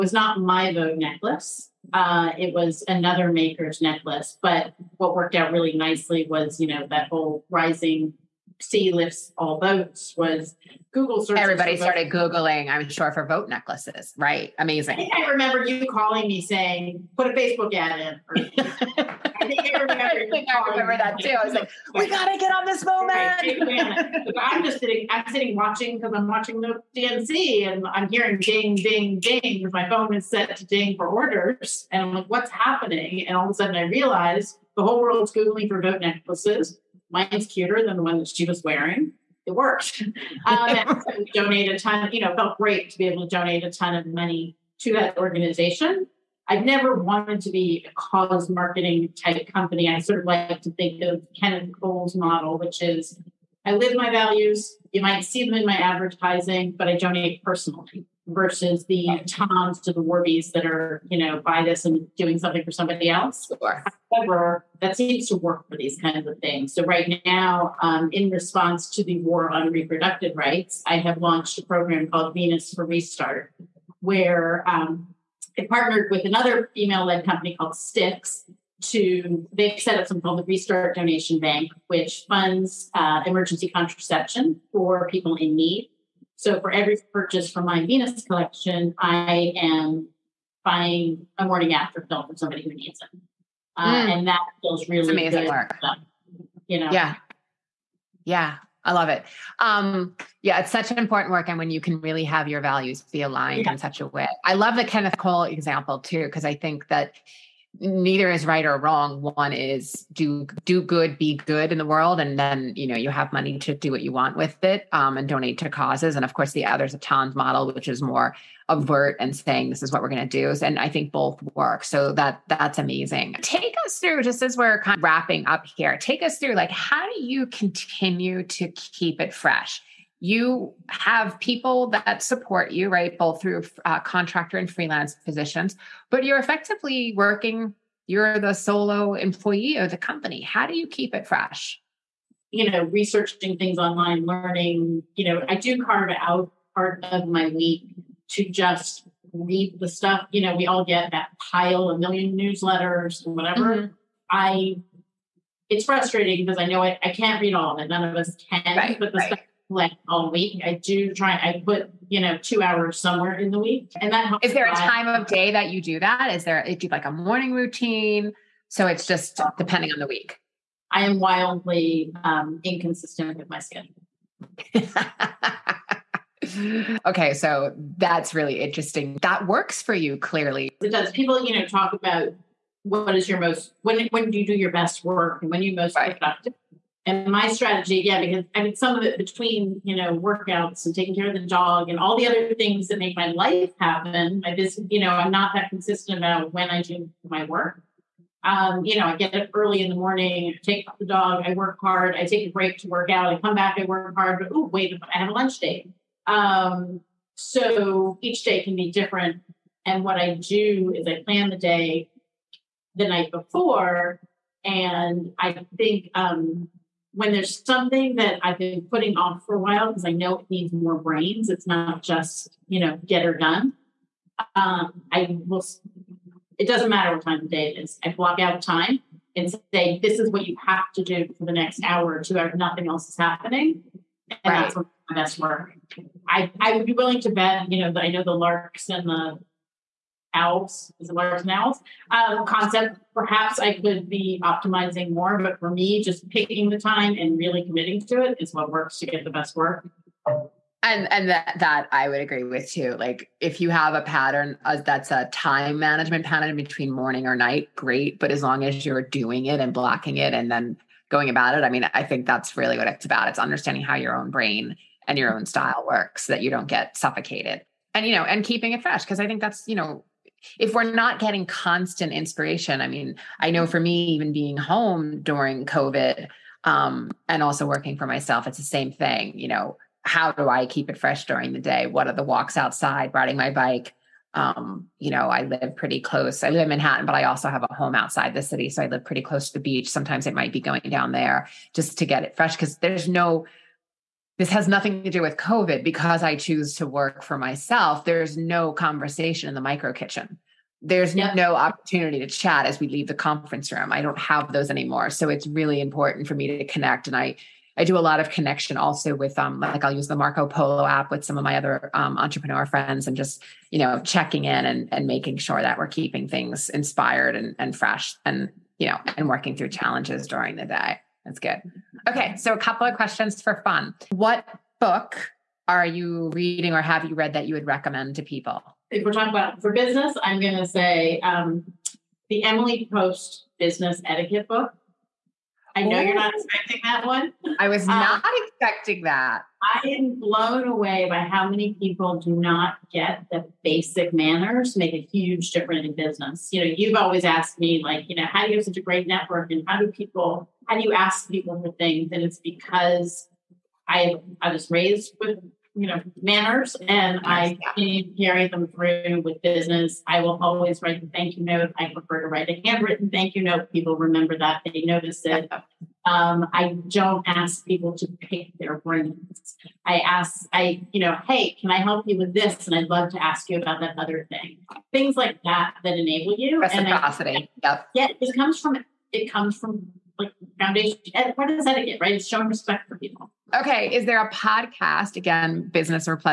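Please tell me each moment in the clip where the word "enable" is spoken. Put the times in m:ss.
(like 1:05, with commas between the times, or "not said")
6:15.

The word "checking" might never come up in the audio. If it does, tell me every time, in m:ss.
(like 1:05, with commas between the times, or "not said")
5:14.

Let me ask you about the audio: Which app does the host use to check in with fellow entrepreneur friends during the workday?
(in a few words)
Marco Polo.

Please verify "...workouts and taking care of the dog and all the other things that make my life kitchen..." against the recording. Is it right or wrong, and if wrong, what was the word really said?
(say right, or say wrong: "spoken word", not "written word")
wrong: "happen", not "kitchen".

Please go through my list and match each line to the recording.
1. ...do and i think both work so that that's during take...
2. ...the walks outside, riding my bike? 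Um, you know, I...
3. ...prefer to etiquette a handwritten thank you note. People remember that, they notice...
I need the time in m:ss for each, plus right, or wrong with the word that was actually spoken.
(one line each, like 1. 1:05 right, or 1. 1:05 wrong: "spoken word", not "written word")
1. 2:00 wrong: "amazing", not "during"
2. 4:42 right
3. 6:01 wrong: "write", not "etiquette".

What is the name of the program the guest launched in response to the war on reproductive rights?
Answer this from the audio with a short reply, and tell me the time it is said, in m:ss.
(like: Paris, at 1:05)
Venus for Restart, at 1:12.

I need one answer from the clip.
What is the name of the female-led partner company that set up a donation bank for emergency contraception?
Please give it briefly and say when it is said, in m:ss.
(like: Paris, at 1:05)
Sticks, at 1:17.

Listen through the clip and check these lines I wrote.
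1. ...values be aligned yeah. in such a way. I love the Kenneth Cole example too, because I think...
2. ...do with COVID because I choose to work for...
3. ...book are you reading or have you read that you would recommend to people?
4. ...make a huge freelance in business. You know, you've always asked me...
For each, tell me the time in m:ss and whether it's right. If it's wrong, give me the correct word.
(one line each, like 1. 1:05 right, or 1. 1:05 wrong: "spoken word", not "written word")
1. 1:42 right
2. 4:55 right
3. 5:24 right
4. 5:44 wrong: "difference", not "freelance".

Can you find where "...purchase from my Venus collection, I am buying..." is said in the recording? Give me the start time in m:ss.
1:27.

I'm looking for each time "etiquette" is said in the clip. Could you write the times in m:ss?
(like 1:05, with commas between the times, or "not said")
5:34, 6:21.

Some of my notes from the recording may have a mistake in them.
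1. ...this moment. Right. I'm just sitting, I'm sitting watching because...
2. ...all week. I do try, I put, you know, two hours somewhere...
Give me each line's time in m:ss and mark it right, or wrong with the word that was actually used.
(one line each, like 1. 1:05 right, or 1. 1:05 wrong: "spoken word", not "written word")
1. 0:22 right
2. 2:40 right.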